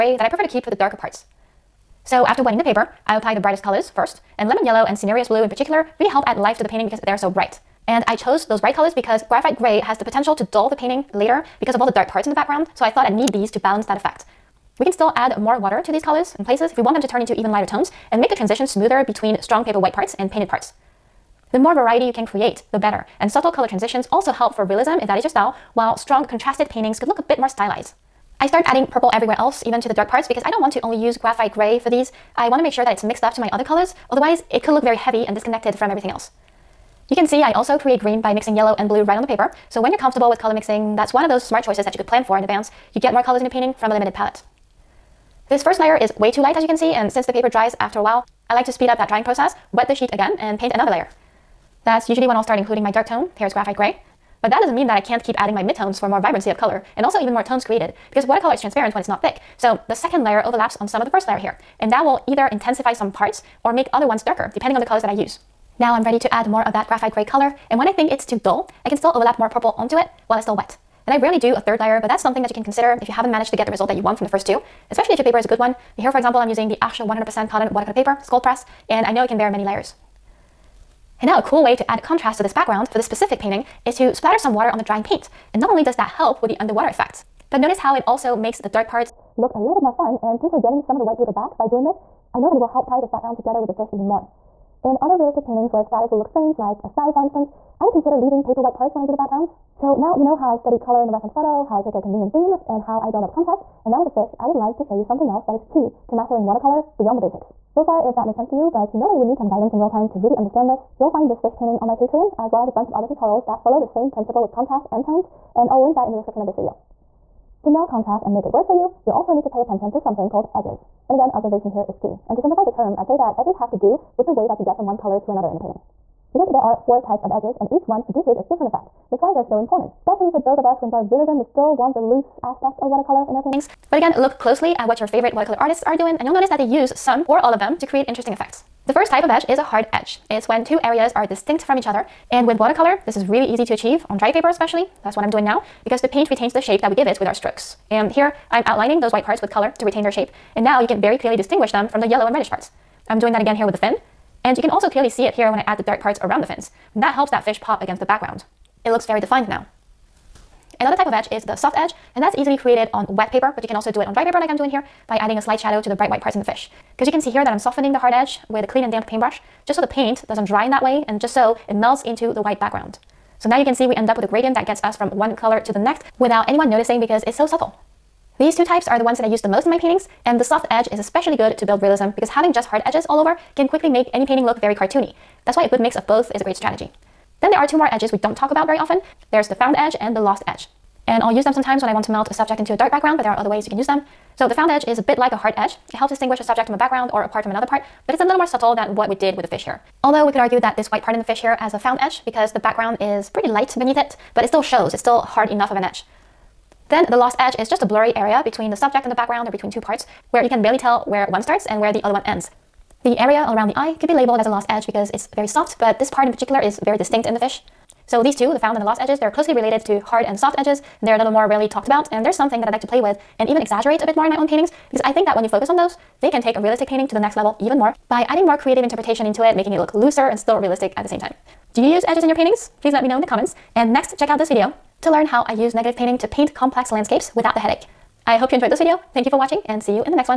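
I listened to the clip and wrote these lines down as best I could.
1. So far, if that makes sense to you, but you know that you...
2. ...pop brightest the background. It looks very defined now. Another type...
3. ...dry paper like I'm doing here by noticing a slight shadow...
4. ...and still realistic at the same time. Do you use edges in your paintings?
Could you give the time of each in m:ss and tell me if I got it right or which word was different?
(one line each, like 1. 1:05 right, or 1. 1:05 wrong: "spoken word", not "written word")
1. 1:47 right
2. 2:37 wrong: "against", not "brightest"
3. 2:44 wrong: "adding", not "noticing"
4. 3:50 right.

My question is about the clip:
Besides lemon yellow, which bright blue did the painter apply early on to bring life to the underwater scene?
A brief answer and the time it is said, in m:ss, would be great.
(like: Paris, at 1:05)
Cinereus blue, at 0:04.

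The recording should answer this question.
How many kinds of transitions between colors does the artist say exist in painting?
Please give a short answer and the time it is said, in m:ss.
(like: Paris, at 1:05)
4, at 2:06.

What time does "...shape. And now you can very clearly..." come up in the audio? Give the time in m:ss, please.
2:30.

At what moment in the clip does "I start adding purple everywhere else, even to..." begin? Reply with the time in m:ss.
0:28.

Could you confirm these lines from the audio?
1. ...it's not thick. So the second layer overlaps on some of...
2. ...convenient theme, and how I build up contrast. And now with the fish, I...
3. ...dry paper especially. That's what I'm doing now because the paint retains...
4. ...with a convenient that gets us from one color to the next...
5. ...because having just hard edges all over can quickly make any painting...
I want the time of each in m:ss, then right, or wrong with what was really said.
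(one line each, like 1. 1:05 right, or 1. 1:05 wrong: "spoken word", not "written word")
1. 0:59 right
2. 1:42 right
3. 2:24 right
4. 2:54 wrong: "gradient", not "convenient"
5. 3:02 right.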